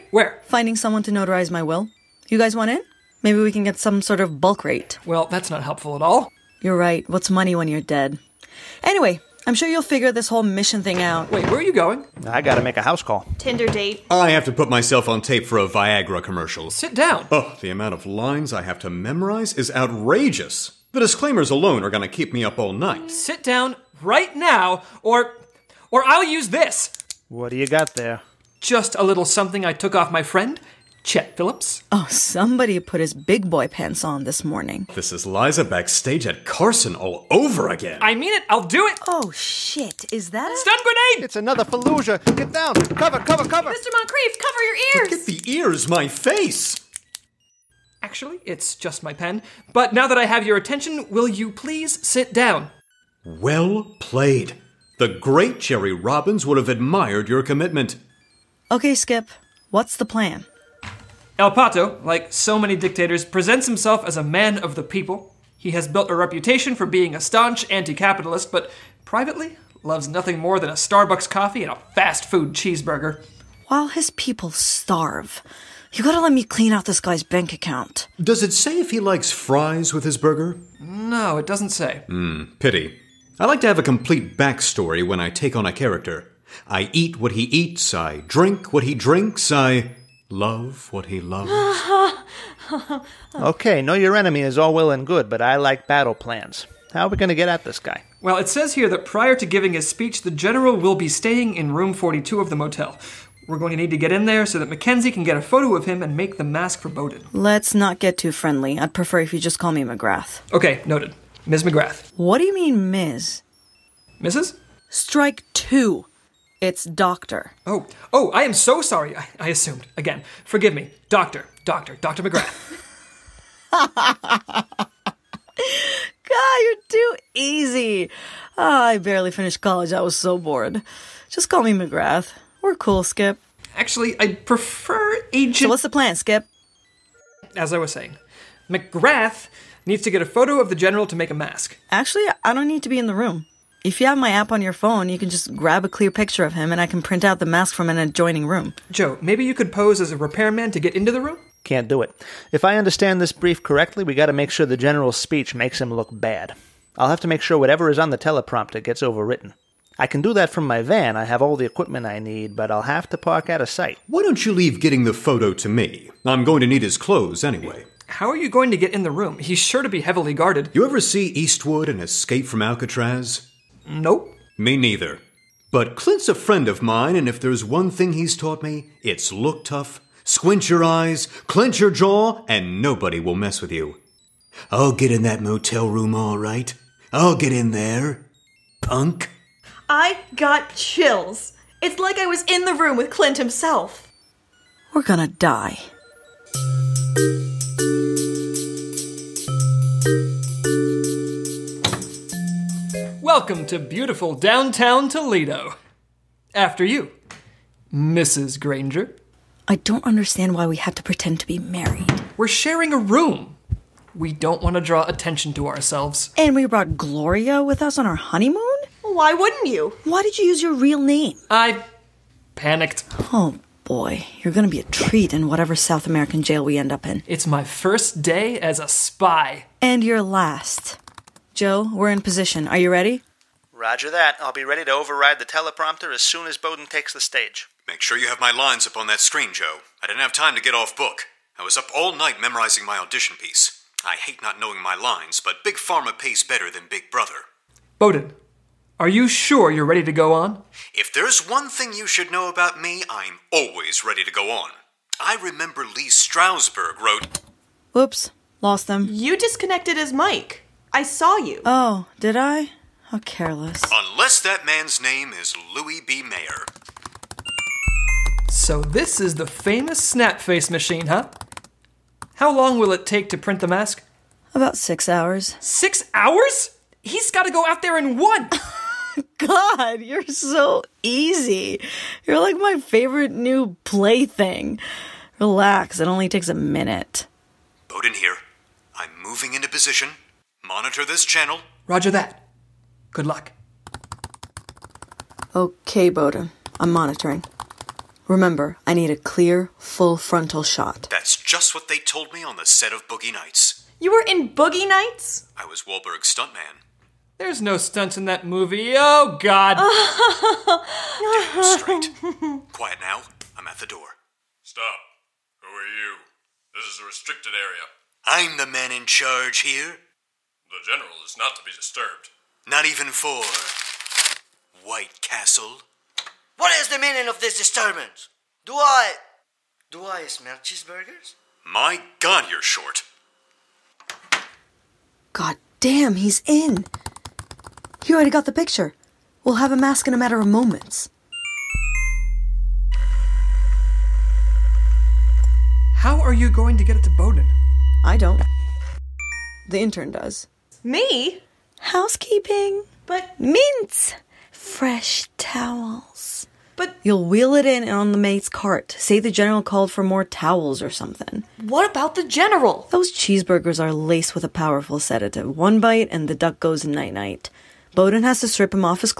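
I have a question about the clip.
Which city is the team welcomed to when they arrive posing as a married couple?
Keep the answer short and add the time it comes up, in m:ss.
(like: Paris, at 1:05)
Toledo, at 3:25.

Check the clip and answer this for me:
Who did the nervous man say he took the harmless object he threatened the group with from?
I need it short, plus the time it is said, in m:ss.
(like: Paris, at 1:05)
Chet Phillips, at 0:31.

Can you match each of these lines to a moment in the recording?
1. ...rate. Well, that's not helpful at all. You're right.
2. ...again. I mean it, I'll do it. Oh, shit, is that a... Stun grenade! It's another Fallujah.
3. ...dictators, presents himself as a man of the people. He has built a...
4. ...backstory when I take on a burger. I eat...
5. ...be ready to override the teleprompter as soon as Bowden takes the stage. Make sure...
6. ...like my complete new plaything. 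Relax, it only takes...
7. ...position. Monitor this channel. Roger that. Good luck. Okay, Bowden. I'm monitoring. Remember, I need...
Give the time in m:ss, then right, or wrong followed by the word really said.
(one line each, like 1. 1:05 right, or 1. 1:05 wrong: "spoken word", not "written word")
1. 0:04 right
2. 0:37 right
3. 1:02 right
4. 1:24 wrong: "character", not "burger"
5. 3:54 right
6. 4:42 wrong: "favorite", not "complete"
7. 4:49 right.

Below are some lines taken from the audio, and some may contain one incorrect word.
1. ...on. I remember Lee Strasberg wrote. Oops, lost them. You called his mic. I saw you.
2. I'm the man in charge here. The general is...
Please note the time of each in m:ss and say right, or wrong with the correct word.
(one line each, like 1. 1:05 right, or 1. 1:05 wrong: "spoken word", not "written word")
1. 4:14 wrong: "disconnected", not "called"
2. 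5:18 right.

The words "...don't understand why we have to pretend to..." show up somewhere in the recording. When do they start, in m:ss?
3:29.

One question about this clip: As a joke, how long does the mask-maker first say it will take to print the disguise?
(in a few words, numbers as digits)
Six hours.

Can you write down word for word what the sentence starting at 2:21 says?
Actually, I don't need to be in the room.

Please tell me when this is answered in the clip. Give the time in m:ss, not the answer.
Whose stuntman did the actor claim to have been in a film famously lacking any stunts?
5:05.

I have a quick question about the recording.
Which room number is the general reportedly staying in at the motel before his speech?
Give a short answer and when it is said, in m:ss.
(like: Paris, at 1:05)
42, at 1:41.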